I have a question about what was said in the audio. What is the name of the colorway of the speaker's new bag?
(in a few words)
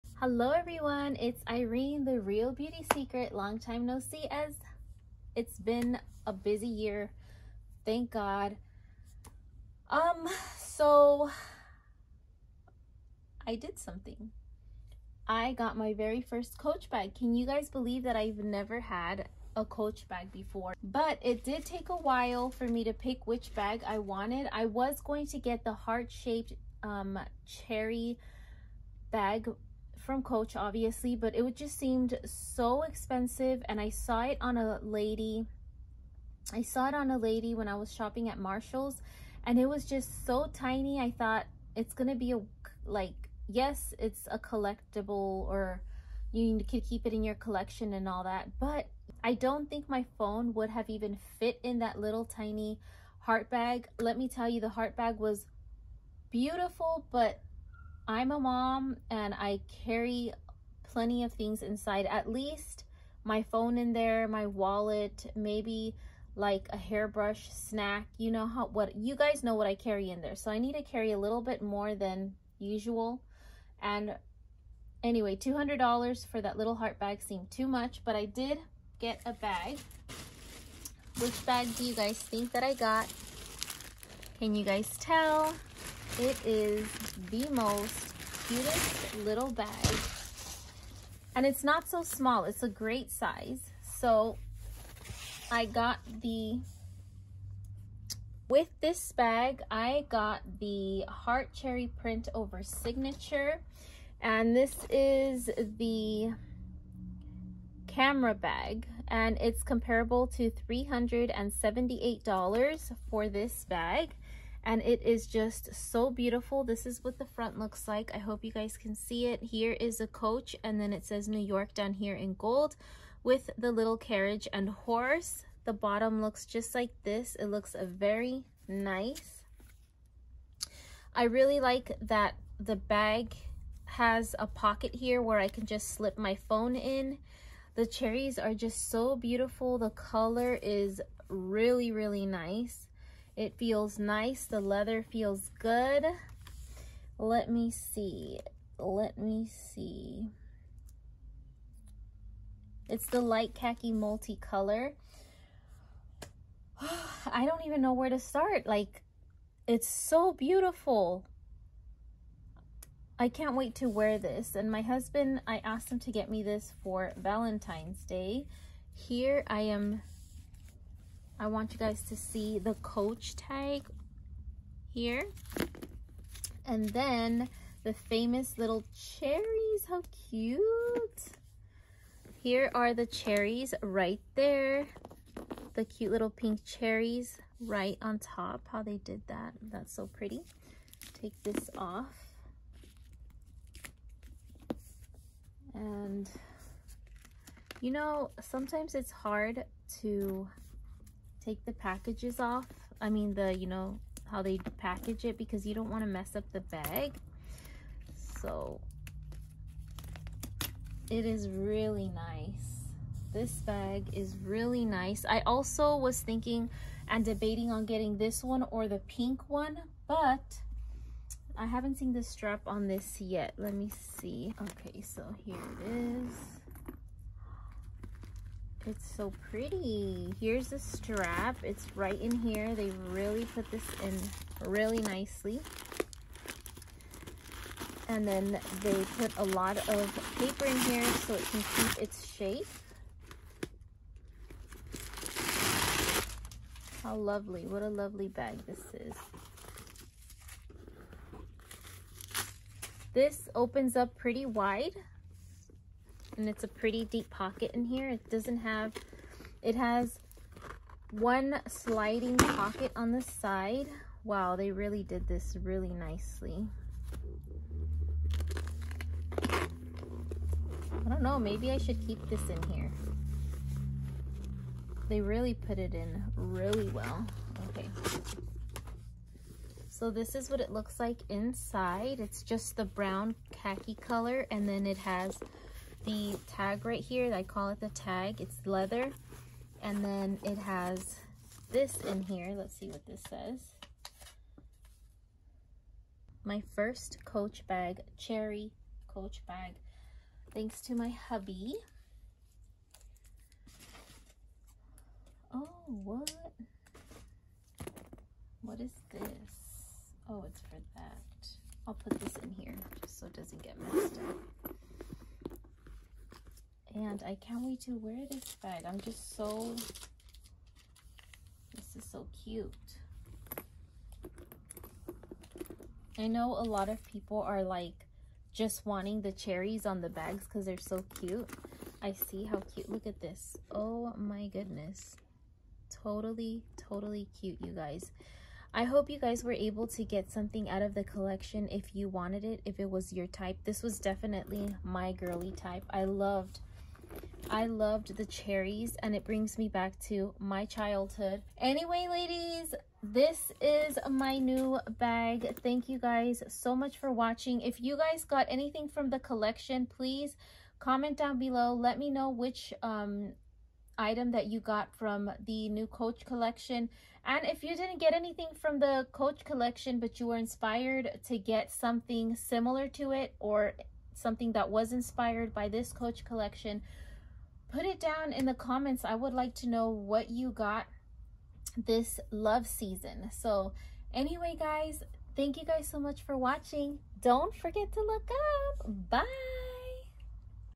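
light khaki multicolor.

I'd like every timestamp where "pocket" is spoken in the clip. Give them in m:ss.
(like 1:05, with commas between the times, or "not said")
2:14, 4:17, 4:22.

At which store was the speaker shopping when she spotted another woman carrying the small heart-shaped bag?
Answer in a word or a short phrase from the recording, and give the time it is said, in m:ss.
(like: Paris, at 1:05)
Marshall's, at 0:38.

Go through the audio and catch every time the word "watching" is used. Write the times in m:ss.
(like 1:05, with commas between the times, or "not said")
5:57, 6:26.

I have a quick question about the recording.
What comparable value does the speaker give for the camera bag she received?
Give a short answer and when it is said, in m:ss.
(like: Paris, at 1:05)
$378, at 1:50.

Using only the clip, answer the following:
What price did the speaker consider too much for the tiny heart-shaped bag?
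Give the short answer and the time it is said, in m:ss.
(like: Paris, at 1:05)
$200, at 1:15.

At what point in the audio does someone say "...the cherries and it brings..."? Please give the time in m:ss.
5:48.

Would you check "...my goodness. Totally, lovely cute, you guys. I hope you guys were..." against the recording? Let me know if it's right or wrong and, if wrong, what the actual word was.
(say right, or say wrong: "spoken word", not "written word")
wrong: "totally", not "lovely".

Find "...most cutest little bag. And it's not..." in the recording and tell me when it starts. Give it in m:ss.
1:27.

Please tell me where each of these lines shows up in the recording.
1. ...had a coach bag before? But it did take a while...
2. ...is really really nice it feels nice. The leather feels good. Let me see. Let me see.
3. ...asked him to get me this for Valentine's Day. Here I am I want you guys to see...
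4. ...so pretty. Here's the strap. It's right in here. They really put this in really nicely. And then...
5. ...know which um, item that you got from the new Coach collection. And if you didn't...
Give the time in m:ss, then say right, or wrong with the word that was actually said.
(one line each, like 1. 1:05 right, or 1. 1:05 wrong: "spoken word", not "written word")
1. 0:18 right
2. 2:20 right
3. 2:45 right
4. 3:49 right
5. 6:02 right.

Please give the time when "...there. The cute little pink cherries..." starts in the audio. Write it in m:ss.
3:04.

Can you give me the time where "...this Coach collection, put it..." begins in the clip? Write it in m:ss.
6:15.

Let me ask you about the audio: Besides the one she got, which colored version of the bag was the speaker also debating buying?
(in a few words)
the pink one.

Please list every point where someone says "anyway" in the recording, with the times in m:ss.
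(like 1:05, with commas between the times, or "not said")
1:15, 5:51, 6:24.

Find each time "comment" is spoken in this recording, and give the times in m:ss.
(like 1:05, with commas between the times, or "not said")
6:00, 6:18.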